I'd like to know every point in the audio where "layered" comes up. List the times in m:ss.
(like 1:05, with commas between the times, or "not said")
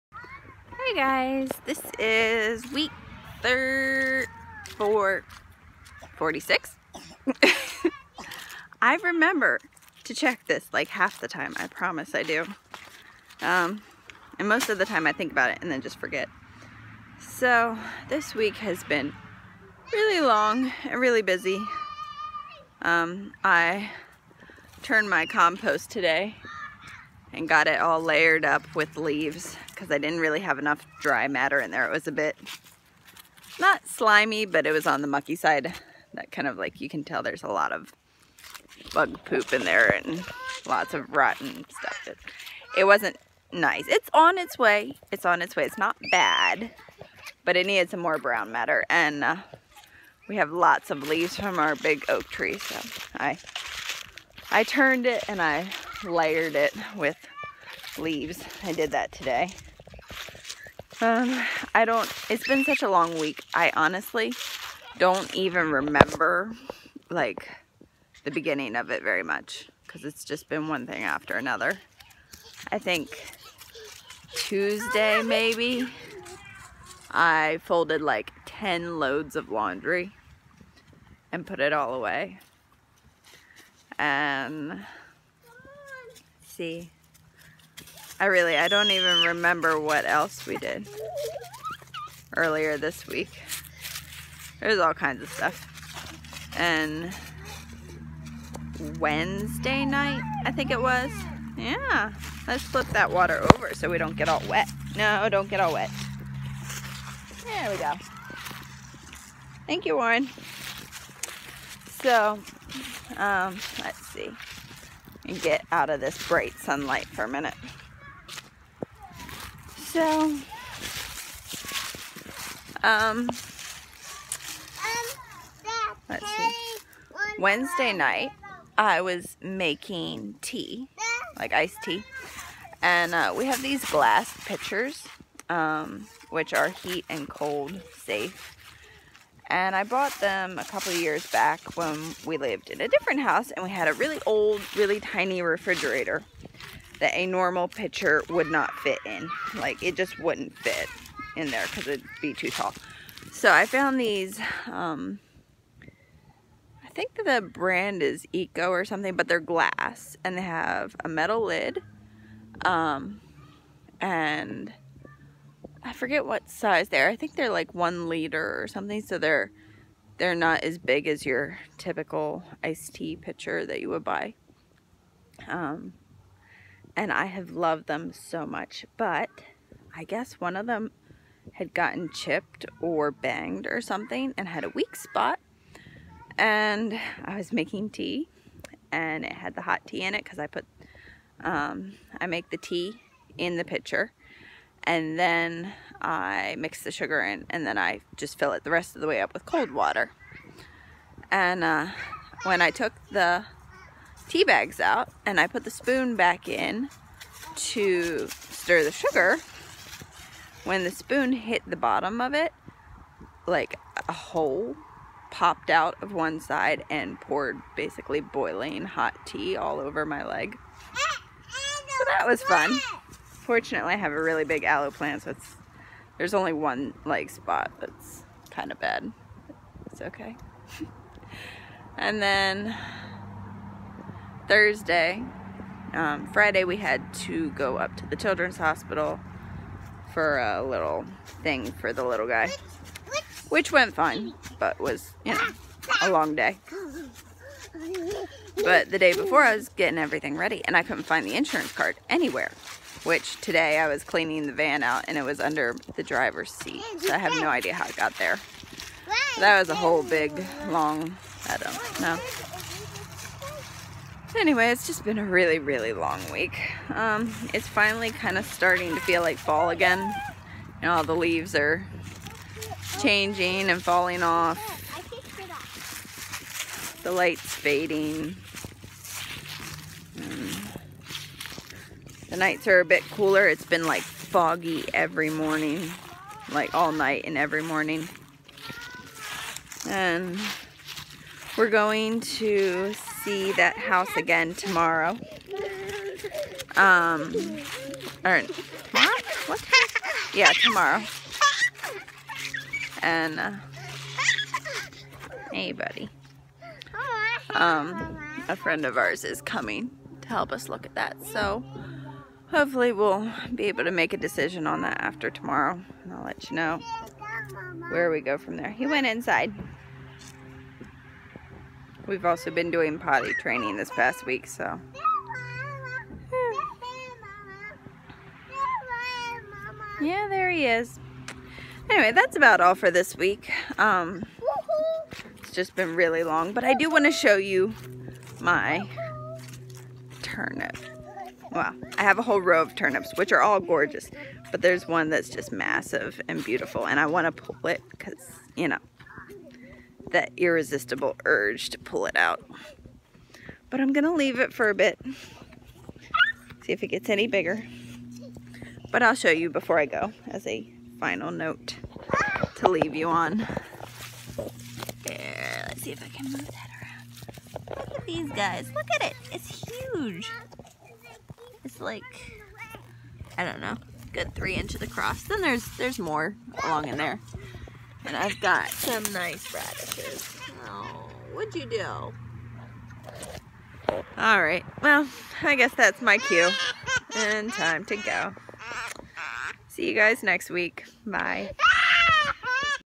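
0:28, 0:56.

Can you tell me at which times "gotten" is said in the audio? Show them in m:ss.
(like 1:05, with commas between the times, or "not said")
3:01.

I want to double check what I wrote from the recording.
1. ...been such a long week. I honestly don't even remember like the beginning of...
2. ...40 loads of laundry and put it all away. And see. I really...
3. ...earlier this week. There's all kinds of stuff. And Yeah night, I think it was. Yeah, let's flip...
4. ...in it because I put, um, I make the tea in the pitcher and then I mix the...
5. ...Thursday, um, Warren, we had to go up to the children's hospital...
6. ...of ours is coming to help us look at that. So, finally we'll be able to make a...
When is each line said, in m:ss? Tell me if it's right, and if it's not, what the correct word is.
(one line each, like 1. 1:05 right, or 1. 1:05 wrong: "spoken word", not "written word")
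1. 1:02 right
2. 1:18 wrong: "10", not "40"
3. 1:32 wrong: "Wednesday", not "Yeah"
4. 3:10 right
5. 3:54 wrong: "Friday", not "Warren"
6. 5:08 wrong: "hopefully", not "finally".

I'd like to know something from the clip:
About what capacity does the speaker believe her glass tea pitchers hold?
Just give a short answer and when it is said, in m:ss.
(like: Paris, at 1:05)
1 liter, at 2:47.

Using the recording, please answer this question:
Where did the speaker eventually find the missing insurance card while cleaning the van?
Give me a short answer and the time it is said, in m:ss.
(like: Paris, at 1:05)
Under the driver's seat, at 4:15.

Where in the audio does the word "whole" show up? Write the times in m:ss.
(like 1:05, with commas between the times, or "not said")
4:19, 5:42.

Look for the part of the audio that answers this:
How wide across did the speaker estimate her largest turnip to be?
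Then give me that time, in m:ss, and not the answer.
6:14.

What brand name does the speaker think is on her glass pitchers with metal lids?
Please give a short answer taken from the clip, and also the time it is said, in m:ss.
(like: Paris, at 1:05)
Eco, at 2:38.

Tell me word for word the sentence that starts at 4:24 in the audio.
anyway, it's just been a really, really long week.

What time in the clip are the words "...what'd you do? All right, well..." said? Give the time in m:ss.
6:21.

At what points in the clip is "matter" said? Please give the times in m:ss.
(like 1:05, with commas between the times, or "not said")
0:31, 0:48.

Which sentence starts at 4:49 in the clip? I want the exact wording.
And we're going to see that house again tomorrow.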